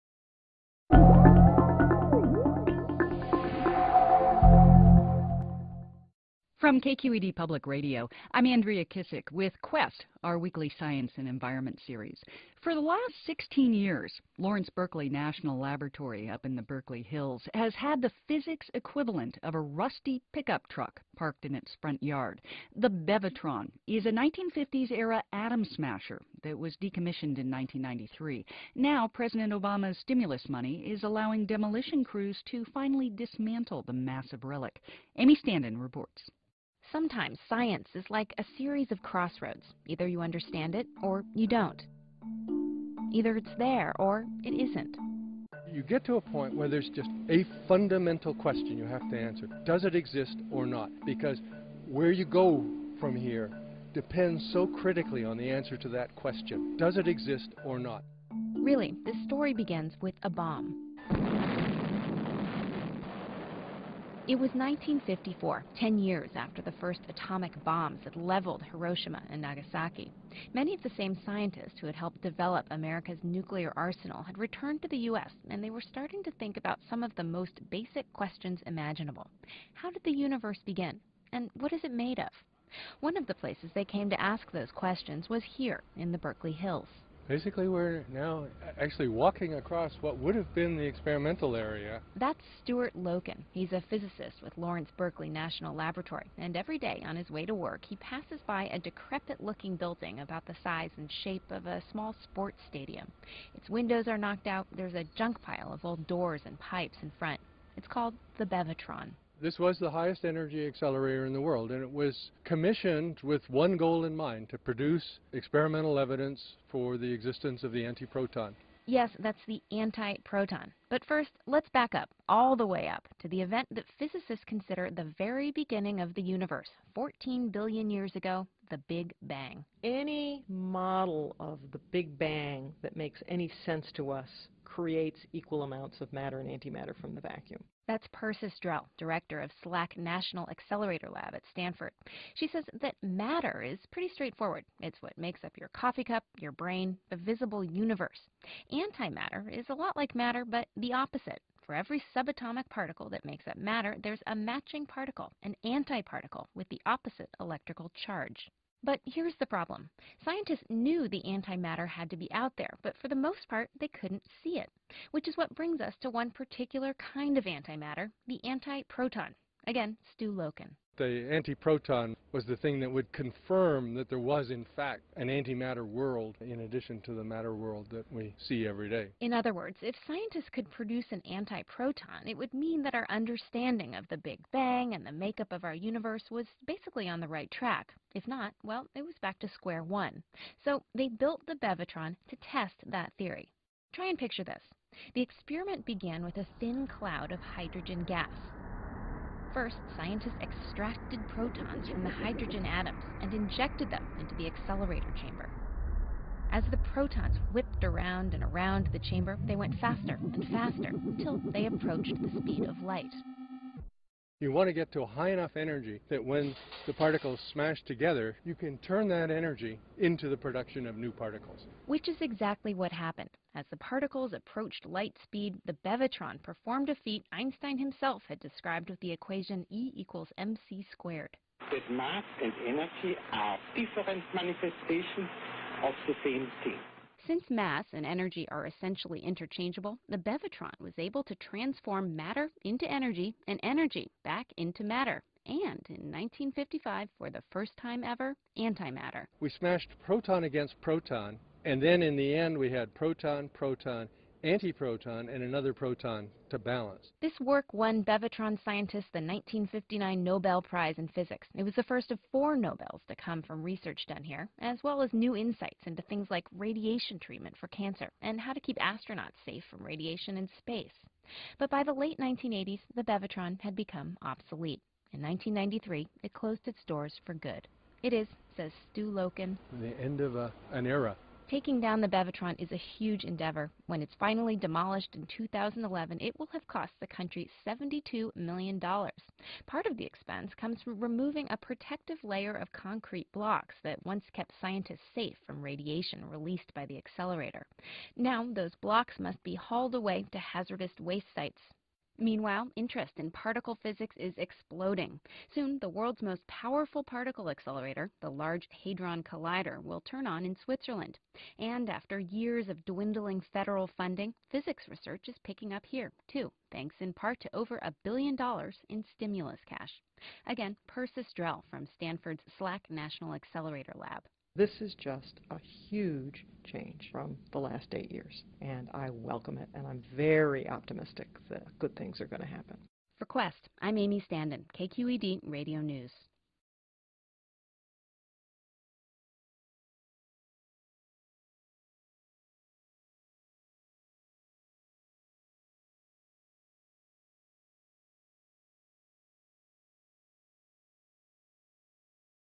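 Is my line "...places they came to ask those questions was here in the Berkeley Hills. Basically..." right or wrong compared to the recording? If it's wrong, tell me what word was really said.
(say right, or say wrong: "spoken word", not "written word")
right.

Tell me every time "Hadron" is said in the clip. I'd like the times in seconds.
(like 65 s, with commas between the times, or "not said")
308 s.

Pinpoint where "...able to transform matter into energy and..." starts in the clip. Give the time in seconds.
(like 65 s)
240 s.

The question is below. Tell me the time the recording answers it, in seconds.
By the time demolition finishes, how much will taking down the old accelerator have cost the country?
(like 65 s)
287 s.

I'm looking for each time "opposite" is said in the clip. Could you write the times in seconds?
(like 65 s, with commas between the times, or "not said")
150 s, 156 s.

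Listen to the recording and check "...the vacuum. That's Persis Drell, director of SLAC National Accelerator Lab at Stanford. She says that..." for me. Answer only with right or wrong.
right.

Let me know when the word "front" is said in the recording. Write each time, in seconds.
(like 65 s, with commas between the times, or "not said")
21 s, 107 s.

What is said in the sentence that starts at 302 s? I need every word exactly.
Meanwhile, interest in particle physics is exploding.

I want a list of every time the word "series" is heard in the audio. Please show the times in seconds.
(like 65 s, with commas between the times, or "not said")
11 s, 38 s.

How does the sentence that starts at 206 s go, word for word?
As the protons whipped around and around the chamber, they went faster and faster until they approached the speed of light.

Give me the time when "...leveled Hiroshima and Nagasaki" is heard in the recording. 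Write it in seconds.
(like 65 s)
68 s.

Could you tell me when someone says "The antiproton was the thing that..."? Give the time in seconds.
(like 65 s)
170 s.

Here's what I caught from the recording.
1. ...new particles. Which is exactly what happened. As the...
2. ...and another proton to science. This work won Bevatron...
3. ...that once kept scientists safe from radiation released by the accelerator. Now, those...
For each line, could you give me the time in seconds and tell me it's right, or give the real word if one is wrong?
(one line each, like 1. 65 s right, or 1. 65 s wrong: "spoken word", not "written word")
1. 220 s right
2. 255 s wrong: "balance", not "science"
3. 293 s right.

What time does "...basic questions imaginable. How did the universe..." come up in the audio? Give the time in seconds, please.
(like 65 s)
77 s.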